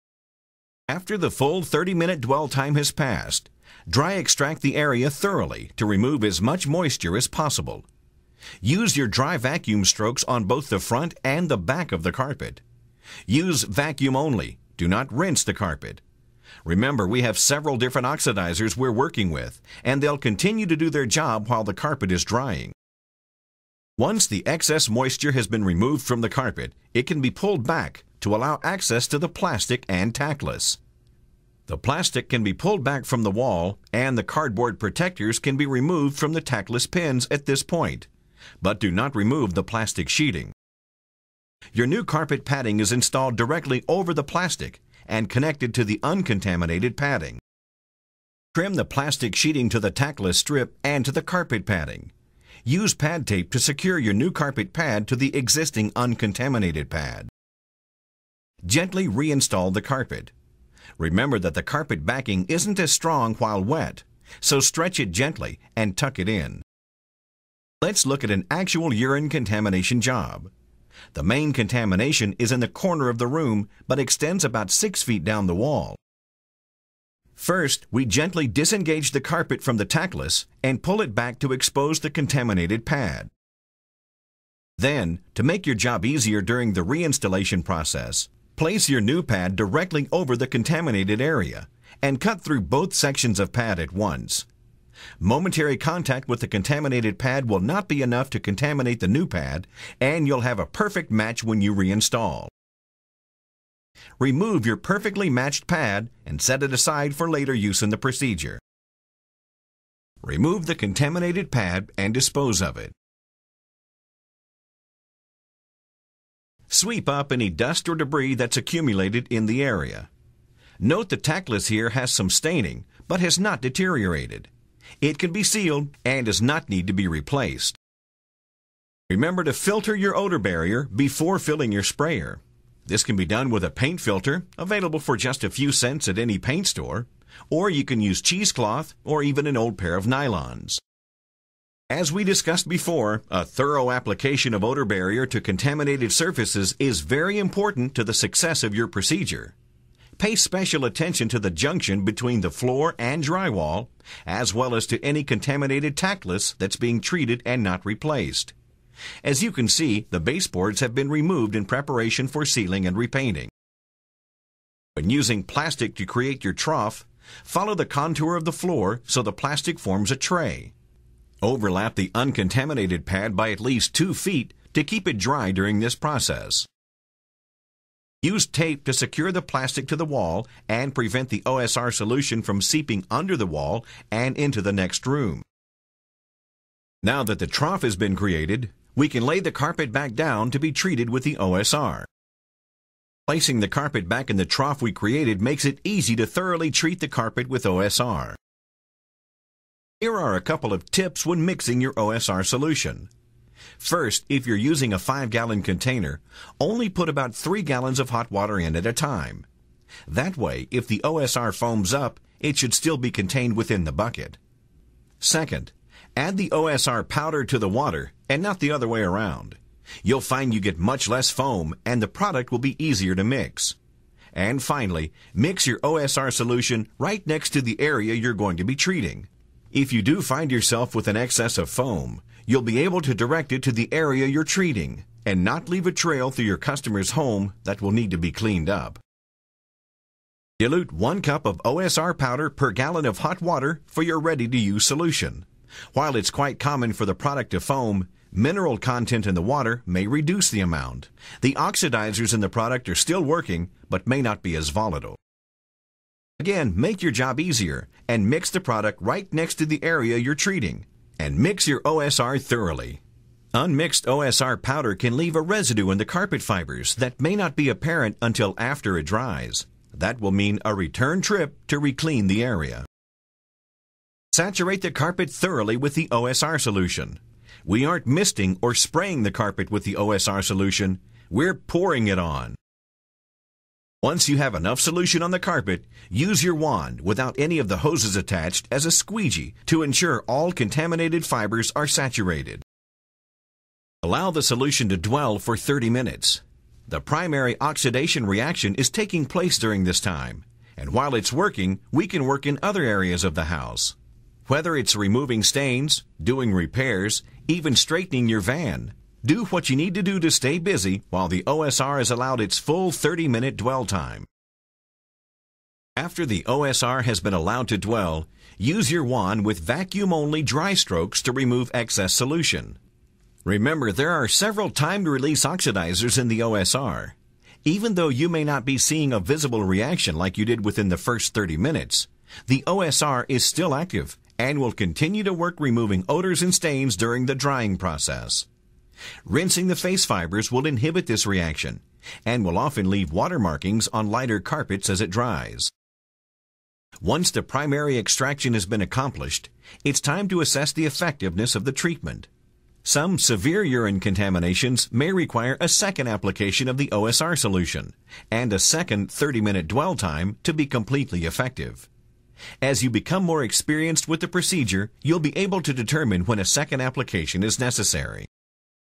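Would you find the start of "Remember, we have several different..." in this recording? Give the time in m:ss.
0:16.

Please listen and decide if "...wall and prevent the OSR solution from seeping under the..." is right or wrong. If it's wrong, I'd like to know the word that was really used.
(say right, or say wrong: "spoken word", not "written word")
right.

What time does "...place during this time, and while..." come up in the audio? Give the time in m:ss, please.
4:59.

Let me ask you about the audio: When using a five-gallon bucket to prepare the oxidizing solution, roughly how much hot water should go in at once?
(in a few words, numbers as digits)
3 gallons.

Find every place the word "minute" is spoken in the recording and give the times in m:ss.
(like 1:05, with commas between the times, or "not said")
0:01, 4:55, 5:13, 5:31, 5:59.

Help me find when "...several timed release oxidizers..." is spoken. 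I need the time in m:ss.
5:24.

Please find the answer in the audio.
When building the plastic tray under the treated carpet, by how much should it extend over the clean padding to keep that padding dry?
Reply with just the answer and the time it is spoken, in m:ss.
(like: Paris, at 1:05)
2 feet, at 2:53.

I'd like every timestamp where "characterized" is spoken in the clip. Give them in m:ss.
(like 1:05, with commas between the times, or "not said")
not said.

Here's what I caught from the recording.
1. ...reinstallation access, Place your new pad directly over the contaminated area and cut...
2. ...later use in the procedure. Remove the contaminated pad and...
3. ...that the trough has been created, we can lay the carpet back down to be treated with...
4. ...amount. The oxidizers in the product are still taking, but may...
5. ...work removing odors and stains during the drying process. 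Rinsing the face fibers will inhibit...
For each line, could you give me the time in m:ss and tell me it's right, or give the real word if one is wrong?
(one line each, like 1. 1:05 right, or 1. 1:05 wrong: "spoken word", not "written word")
1. 1:26 wrong: "process", not "access"
2. 1:47 right
3. 3:07 right
4. 4:10 wrong: "working", not "taking"
5. 5:35 right.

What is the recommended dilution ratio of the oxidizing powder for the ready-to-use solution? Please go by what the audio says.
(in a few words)
1 cup per gallon.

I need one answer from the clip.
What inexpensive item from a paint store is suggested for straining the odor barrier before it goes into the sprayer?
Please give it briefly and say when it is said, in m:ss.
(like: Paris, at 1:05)
paint filter, at 2:13.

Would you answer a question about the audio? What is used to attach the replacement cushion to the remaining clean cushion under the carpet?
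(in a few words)
pad tape.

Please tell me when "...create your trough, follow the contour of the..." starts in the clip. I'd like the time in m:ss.
2:46.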